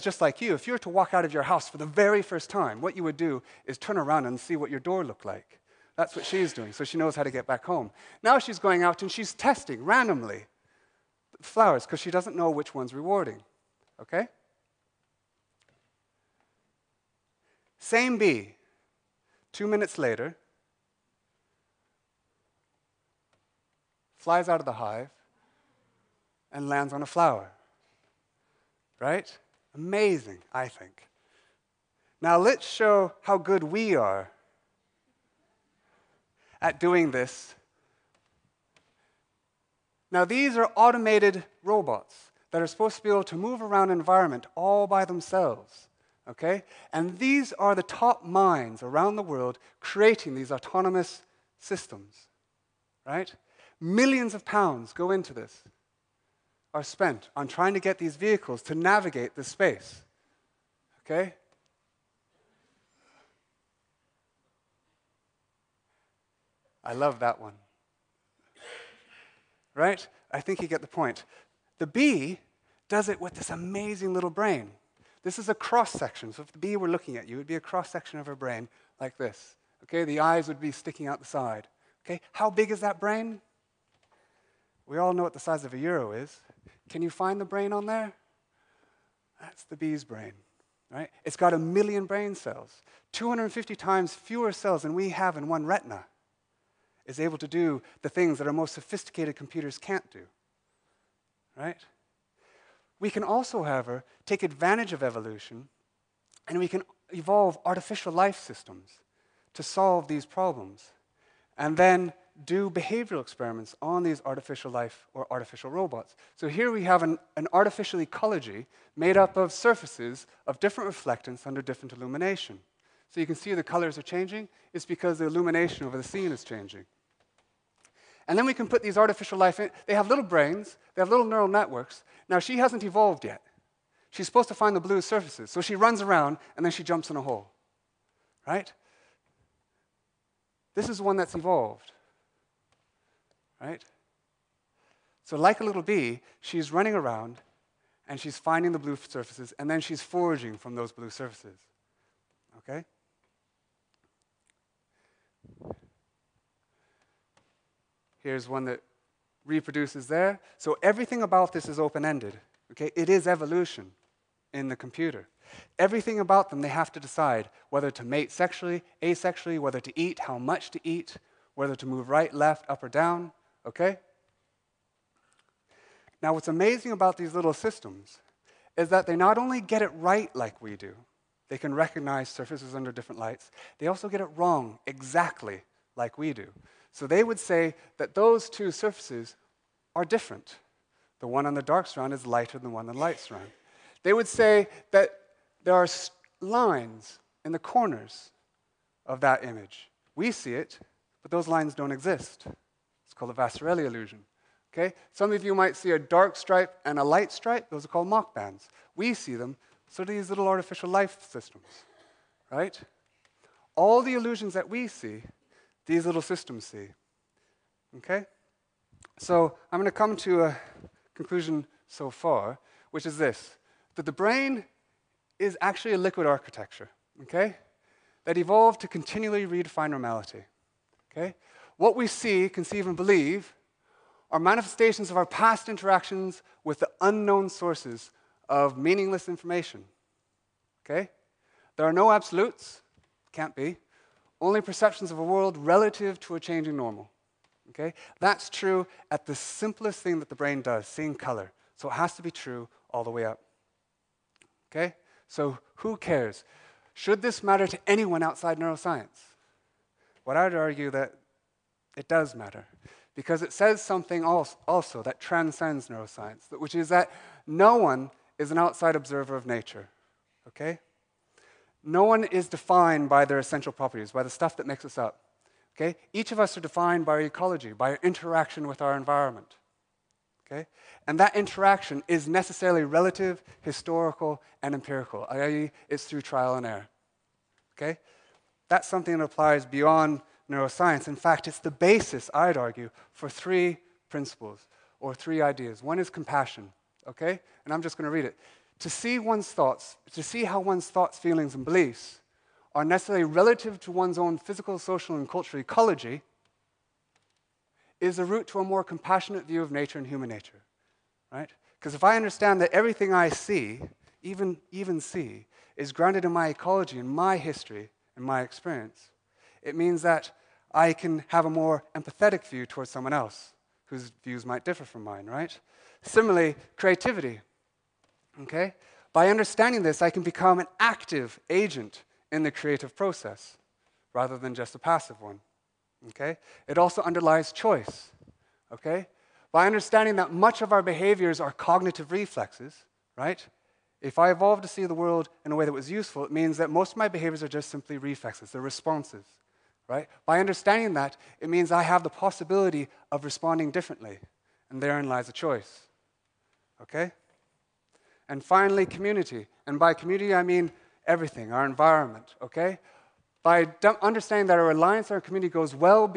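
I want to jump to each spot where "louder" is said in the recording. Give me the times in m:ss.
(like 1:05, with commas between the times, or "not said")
not said.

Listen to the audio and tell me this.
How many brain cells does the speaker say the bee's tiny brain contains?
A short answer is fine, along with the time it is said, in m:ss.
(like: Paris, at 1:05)
1 million, at 1:31.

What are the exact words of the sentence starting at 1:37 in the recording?
Is able to do the things that our most sophisticated computers can't do, right?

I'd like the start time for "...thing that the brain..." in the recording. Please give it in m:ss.
4:10.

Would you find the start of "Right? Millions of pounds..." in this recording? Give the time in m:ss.
0:53.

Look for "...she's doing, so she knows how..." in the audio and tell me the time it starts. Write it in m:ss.
0:06.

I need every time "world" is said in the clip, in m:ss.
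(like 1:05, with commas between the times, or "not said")
0:49, 4:05, 5:44.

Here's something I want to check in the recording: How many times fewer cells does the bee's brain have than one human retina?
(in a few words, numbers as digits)
250.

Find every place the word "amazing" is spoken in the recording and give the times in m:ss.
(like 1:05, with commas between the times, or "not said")
0:29, 1:13, 2:56.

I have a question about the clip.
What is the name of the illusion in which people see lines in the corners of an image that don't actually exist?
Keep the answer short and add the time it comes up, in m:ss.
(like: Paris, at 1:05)
Vasarely illusion, at 3:23.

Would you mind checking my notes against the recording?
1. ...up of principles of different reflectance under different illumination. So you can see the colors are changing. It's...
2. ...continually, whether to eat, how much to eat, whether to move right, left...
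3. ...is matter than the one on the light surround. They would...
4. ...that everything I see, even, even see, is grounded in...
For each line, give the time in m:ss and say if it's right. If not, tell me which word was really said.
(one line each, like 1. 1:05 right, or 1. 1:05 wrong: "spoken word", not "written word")
1. 1:59 wrong: "surfaces", not "principles"
2. 2:49 wrong: "asexually", not "continually"
3. 3:12 wrong: "lighter", not "matter"
4. 5:12 right.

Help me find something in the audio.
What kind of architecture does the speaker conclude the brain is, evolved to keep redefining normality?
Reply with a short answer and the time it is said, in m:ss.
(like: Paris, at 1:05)
Liquid architecture, at 3:45.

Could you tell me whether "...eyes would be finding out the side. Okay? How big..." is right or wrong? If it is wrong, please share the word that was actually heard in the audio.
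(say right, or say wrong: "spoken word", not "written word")
wrong: "sticking", not "finding".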